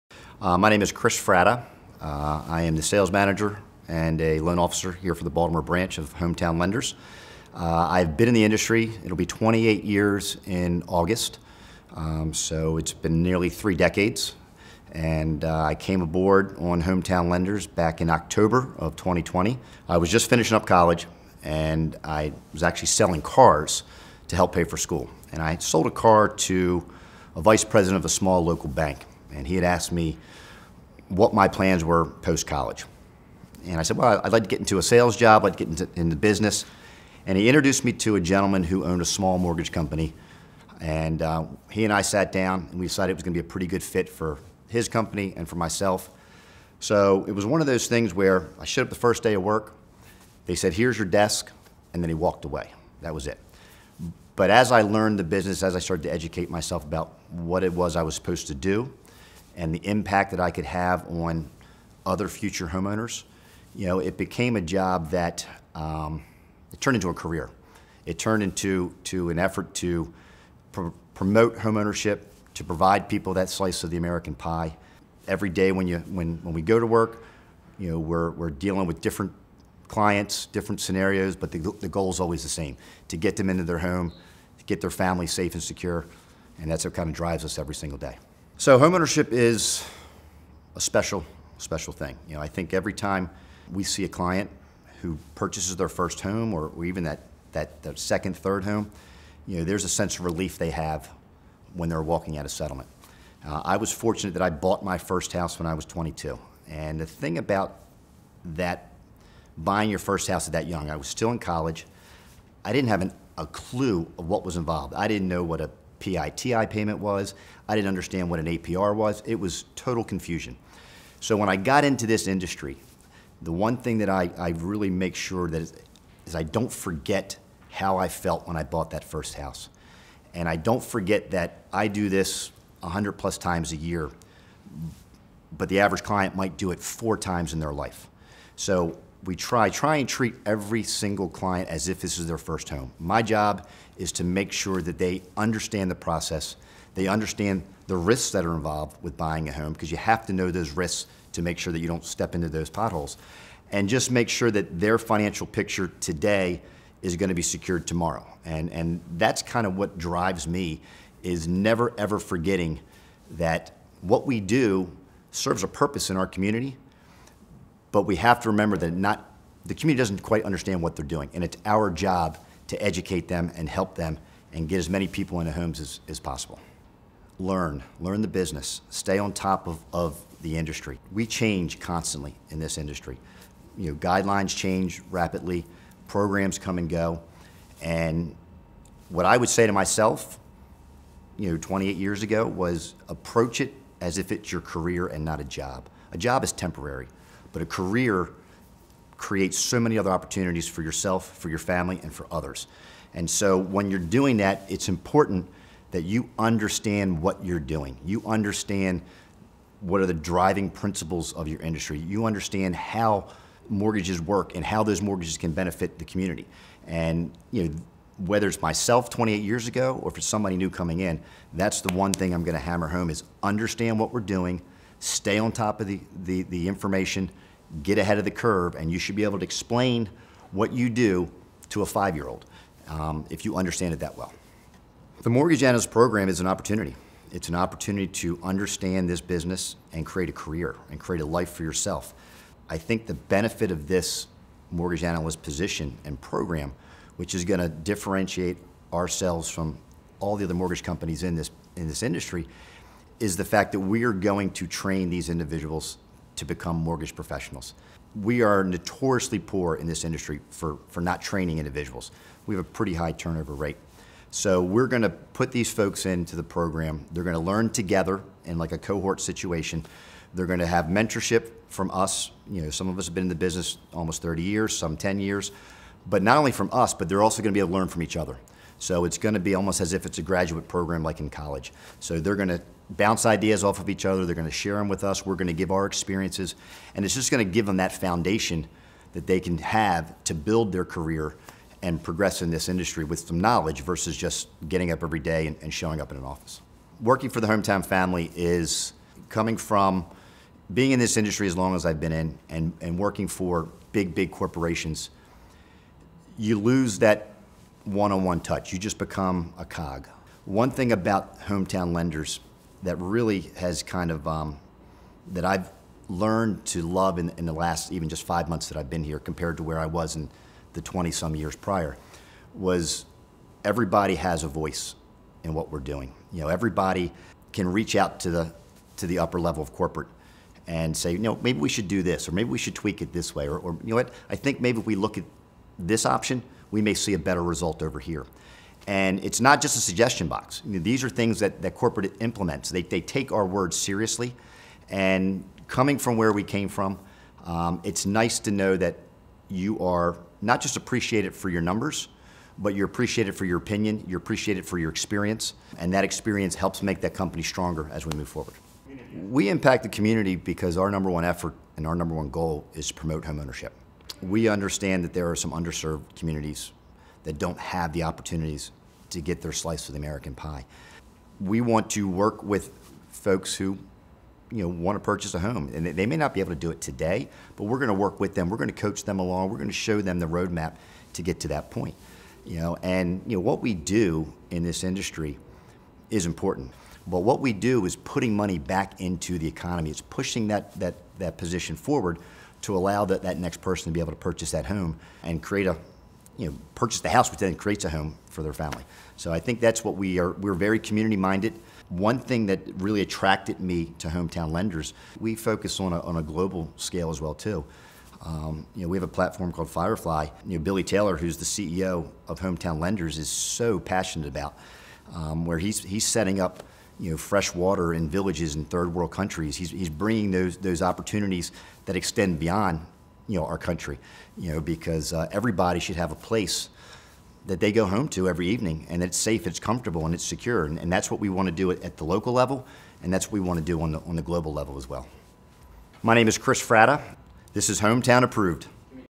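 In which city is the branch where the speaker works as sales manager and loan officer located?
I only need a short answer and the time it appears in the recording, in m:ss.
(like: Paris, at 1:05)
Baltimore, at 0:05.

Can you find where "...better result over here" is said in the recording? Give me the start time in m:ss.
5:37.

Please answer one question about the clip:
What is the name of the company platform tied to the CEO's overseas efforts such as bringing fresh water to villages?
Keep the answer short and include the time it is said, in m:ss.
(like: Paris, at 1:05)
Firefly, at 6:49.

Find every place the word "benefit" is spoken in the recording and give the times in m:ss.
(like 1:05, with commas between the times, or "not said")
3:35, 4:03.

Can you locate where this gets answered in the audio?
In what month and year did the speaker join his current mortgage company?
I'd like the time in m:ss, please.
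0:18.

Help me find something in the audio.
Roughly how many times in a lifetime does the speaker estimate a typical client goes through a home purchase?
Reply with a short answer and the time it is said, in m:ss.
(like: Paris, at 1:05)
4, at 2:16.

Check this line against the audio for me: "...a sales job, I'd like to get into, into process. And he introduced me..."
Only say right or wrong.
wrong.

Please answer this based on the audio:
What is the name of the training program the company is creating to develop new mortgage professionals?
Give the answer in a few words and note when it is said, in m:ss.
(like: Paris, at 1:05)
Mortgage Analyst Program, at 3:55.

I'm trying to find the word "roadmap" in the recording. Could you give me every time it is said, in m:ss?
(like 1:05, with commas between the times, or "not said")
6:20.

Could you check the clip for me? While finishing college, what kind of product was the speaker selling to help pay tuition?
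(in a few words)
Cars.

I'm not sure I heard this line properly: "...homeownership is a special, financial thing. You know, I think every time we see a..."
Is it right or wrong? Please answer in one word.
wrong.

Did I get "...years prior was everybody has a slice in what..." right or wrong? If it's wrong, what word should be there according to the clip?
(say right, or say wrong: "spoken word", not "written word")
wrong: "voice", not "slice".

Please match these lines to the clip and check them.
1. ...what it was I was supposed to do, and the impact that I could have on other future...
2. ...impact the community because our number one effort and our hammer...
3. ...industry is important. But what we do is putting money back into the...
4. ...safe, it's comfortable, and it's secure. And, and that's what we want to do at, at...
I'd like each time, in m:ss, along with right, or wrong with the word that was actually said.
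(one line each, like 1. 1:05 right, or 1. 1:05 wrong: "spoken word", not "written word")
1. 0:57 right
2. 5:59 wrong: "number", not "hammer"
3. 6:24 right
4. 7:09 right.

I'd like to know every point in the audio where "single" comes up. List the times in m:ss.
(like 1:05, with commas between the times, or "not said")
1:27, 2:20.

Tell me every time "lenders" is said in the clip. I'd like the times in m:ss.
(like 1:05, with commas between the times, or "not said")
0:06, 0:17, 5:11, 6:44, 6:52.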